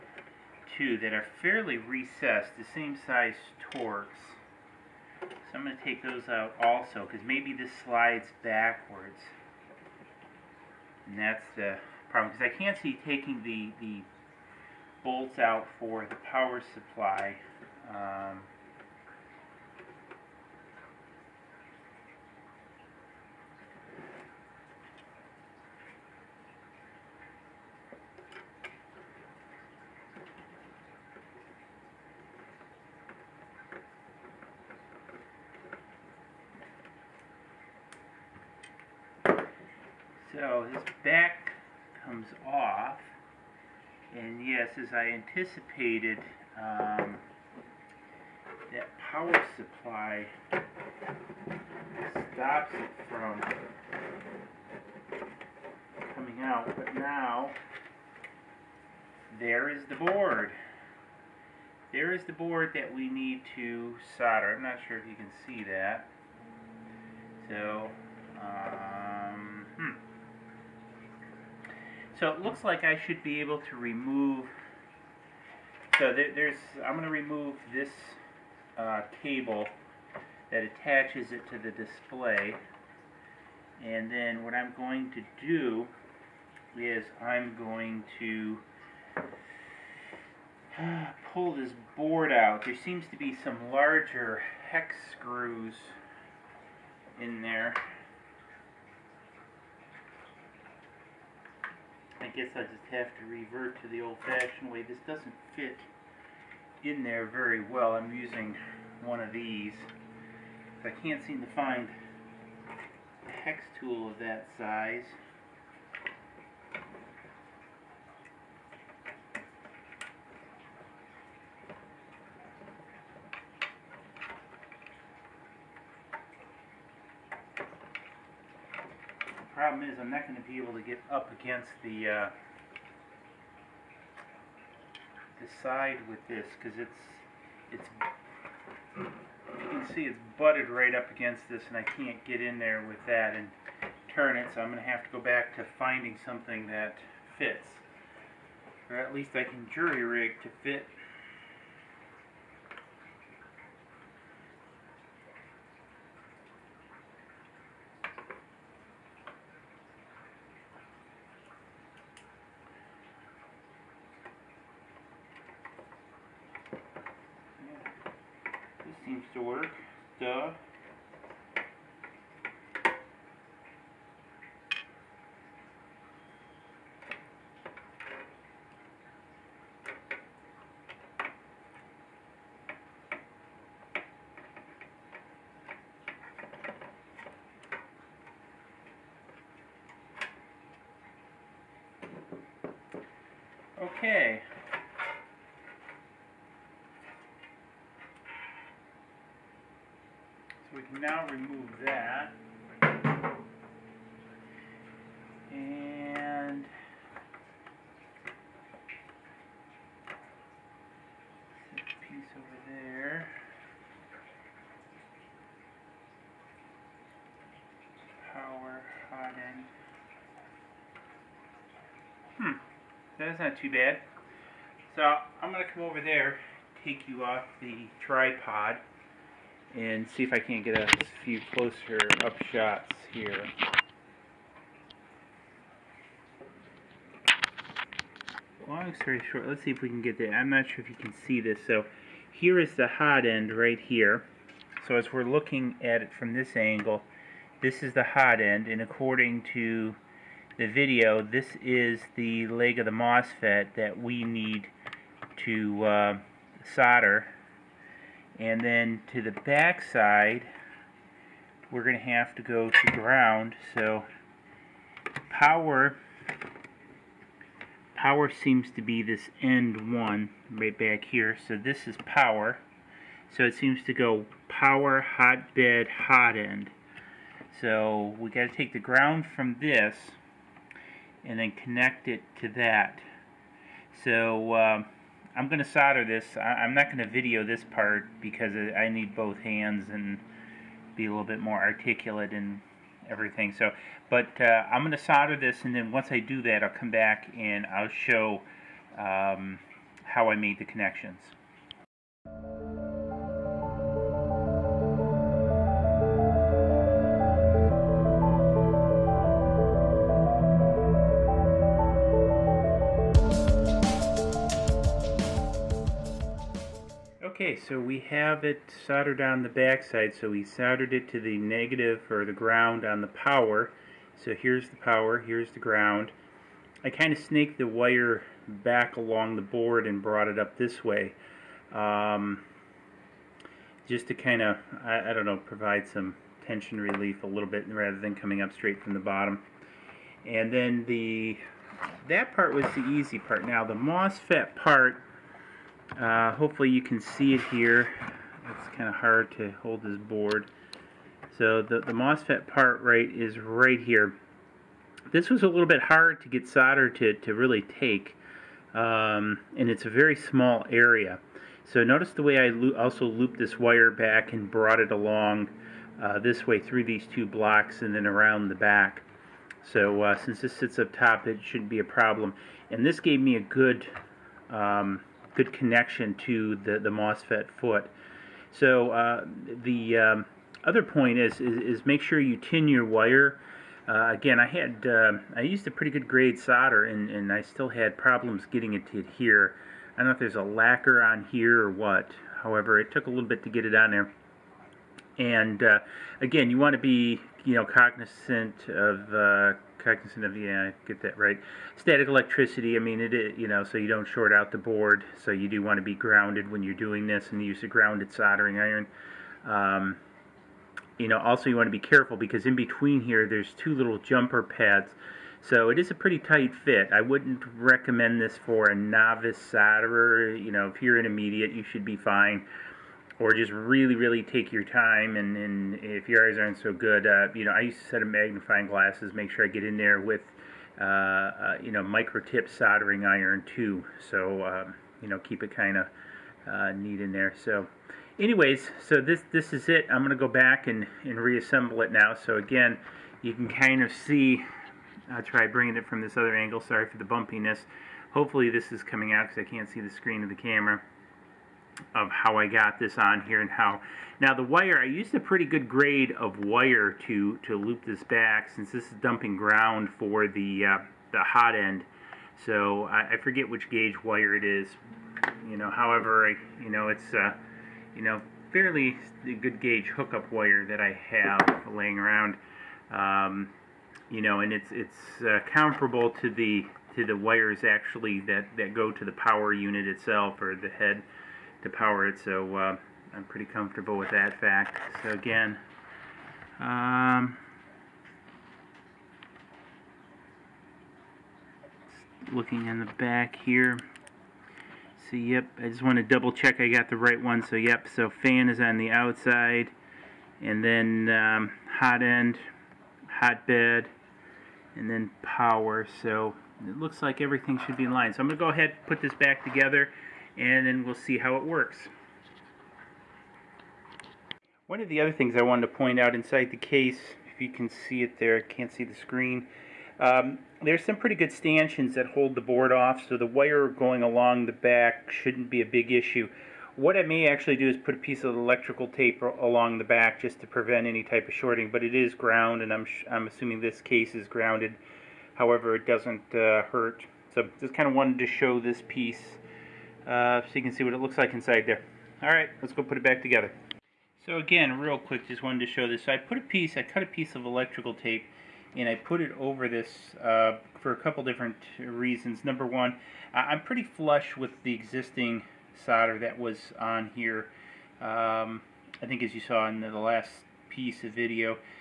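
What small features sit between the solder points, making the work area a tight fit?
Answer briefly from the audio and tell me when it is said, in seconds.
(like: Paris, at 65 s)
two little jumper pads, at 413 s.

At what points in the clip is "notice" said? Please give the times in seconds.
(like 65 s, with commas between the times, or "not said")
361 s.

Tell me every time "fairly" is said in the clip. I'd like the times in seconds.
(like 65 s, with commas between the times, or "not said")
1 s, 468 s.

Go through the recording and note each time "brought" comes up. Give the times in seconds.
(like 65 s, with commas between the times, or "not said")
329 s, 364 s.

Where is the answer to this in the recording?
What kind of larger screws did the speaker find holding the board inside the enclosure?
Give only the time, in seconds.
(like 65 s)
94 s.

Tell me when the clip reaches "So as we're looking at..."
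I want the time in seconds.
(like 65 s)
244 s.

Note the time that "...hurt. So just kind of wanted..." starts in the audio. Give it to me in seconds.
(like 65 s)
536 s.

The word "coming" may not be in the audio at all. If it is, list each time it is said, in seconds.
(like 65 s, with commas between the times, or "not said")
56 s, 338 s, 448 s.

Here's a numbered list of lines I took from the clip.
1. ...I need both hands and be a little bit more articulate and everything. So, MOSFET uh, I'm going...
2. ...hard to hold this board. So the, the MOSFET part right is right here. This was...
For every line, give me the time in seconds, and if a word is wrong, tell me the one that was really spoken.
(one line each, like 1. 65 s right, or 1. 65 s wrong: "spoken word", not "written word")
1. 288 s wrong: "But", not "MOSFET"
2. 348 s right.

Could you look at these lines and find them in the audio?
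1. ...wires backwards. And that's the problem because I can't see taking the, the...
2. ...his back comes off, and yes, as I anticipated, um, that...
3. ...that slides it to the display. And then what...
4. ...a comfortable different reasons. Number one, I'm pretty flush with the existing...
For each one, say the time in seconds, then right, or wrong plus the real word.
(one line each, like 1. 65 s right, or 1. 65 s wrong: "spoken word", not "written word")
1. 7 s wrong: "slides", not "wires"
2. 40 s right
3. 80 s wrong: "attaches", not "slides"
4. 550 s wrong: "couple", not "comfortable".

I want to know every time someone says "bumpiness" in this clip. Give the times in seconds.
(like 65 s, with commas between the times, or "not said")
447 s.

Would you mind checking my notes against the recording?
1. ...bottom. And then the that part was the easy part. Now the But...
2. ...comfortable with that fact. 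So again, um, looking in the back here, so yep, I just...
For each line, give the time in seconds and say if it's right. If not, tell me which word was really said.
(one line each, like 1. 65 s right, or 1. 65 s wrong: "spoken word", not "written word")
1. 338 s wrong: "MOSFET", not "But"
2. 483 s right.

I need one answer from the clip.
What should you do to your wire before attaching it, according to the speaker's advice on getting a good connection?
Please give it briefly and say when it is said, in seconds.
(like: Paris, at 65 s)
tin your wire, at 382 s.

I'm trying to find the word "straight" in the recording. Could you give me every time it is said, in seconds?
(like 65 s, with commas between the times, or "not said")
338 s.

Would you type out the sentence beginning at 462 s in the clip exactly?
So I, I, forget which gauge wire it is.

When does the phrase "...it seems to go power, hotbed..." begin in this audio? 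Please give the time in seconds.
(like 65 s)
273 s.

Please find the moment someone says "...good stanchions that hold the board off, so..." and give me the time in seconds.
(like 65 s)
521 s.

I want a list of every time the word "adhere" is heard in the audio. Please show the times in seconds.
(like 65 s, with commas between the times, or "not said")
388 s.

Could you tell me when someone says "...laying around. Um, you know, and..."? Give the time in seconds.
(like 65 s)
471 s.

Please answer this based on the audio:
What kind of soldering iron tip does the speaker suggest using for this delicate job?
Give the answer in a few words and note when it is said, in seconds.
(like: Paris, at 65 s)
micro tip, at 431 s.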